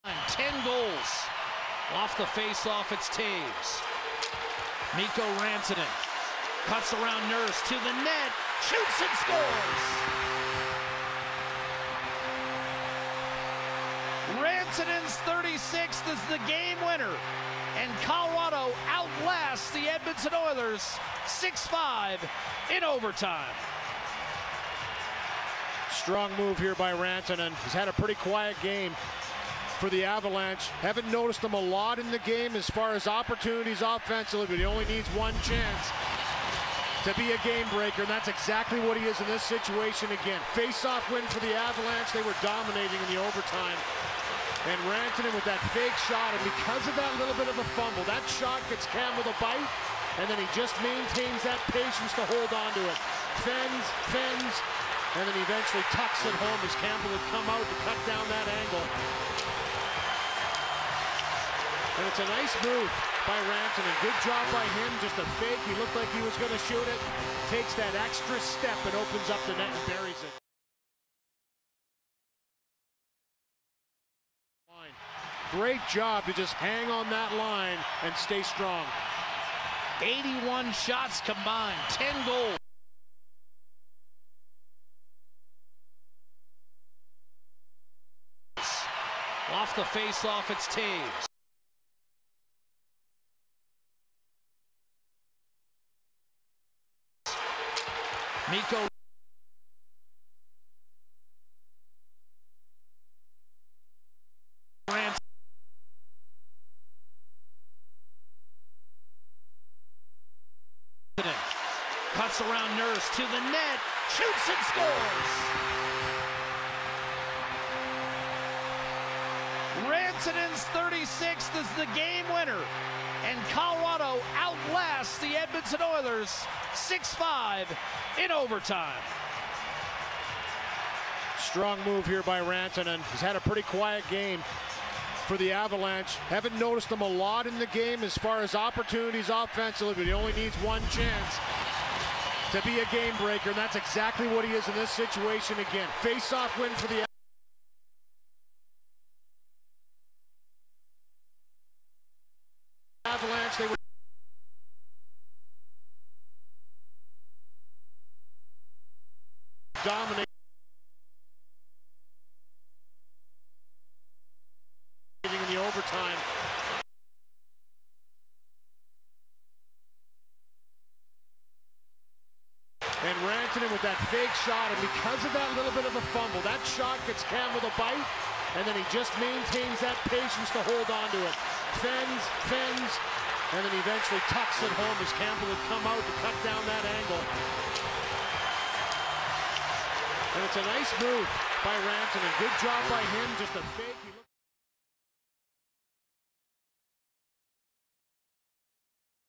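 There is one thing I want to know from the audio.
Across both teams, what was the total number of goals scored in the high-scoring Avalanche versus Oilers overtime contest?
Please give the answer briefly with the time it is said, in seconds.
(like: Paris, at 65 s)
10, at 81 s.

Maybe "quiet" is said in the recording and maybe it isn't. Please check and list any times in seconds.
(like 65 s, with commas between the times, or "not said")
28 s, 133 s.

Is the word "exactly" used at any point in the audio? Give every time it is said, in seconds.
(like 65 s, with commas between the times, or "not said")
38 s, 143 s.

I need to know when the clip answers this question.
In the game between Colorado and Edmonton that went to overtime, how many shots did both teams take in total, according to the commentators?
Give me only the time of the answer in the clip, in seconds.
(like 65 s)
80 s.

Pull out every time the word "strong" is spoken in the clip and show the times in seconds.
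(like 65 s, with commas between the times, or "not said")
25 s, 78 s, 131 s.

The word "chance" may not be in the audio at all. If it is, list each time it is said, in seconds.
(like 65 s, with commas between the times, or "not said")
35 s, 140 s.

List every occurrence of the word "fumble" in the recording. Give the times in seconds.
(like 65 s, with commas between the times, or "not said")
47 s, 176 s.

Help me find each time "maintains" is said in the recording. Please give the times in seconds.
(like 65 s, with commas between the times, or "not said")
50 s, 179 s.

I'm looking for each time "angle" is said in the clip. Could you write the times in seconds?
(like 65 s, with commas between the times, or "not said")
58 s, 186 s.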